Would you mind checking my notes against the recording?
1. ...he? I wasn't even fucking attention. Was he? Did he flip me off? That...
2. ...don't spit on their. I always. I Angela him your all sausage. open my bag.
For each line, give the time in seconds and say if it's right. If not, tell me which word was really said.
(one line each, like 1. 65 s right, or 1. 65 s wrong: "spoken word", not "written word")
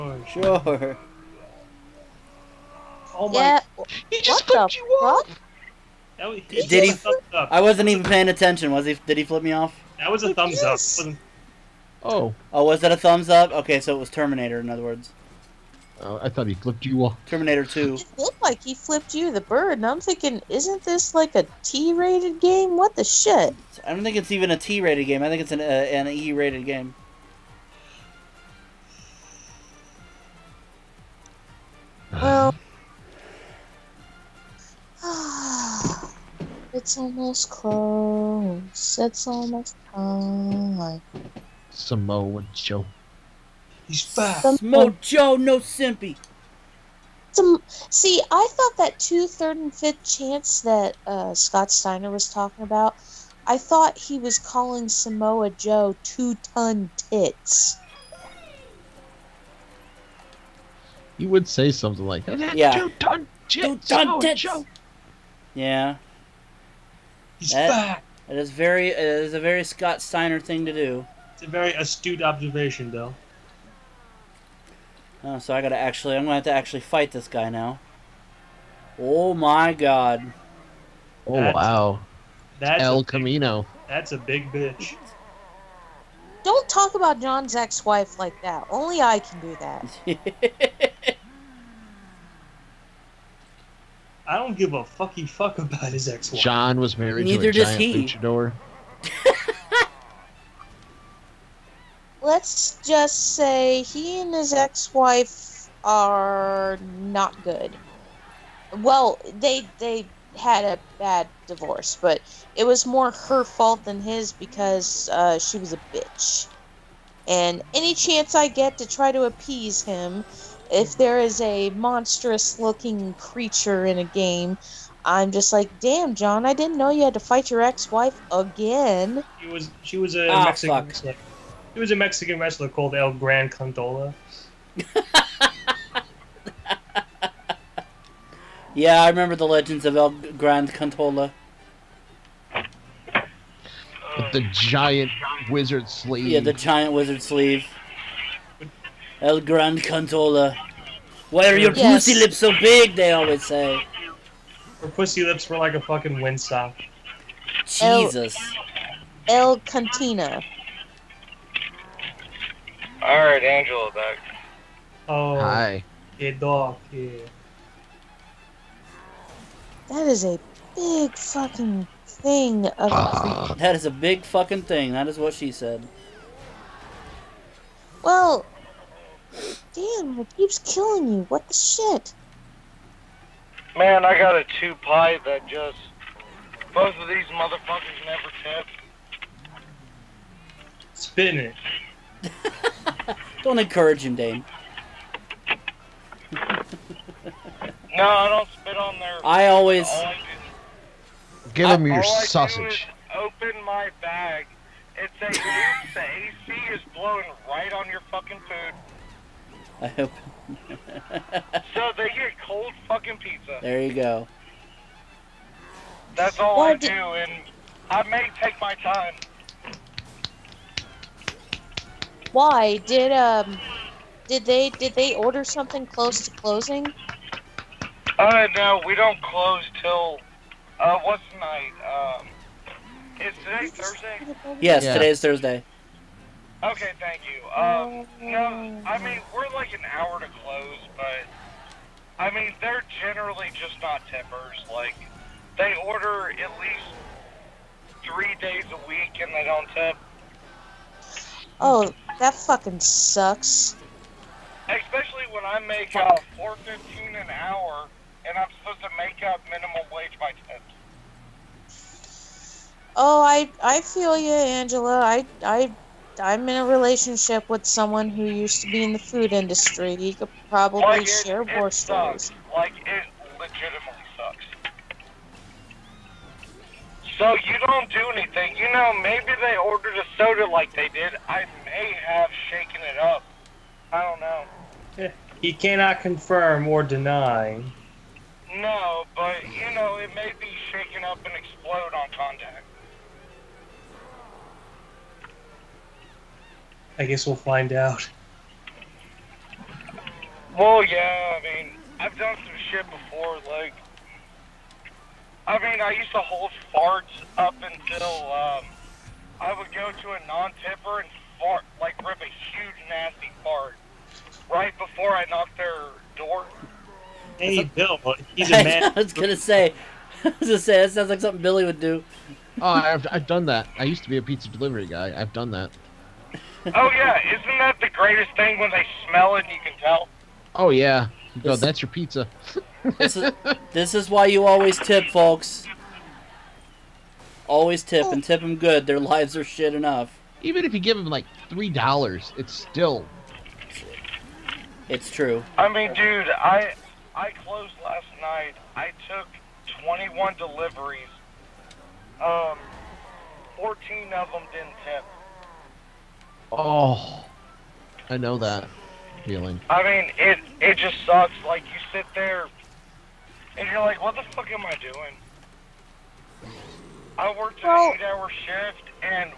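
1. 6 s wrong: "paying", not "fucking"
2. 198 s wrong: "Give", not "Angela".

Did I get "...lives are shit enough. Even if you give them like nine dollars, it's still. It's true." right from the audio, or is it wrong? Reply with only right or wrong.
wrong.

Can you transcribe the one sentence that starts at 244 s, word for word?
Like they order at least three days a week and they don't tip.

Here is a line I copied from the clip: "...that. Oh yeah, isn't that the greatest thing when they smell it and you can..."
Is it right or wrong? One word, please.
right.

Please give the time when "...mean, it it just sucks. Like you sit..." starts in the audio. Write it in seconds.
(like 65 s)
359 s.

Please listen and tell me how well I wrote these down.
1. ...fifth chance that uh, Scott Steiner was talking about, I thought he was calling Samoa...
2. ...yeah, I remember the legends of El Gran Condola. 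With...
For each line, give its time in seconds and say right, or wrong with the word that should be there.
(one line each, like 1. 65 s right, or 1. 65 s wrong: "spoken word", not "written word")
1. 49 s right
2. 138 s right.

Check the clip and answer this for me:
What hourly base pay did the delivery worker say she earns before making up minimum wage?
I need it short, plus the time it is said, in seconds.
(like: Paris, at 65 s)
$4.15, at 256 s.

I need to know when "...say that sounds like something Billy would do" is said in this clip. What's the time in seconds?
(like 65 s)
320 s.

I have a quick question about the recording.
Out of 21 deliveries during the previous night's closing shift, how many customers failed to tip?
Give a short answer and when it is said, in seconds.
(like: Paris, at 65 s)
14, at 353 s.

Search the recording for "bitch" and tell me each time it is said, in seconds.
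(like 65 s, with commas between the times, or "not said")
84 s, 115 s.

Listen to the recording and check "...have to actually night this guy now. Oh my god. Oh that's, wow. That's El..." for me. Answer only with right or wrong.
wrong.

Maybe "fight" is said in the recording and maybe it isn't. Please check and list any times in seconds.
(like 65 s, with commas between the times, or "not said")
76 s, 127 s.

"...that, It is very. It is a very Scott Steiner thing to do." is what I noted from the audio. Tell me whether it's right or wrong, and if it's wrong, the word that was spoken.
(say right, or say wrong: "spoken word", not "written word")
right.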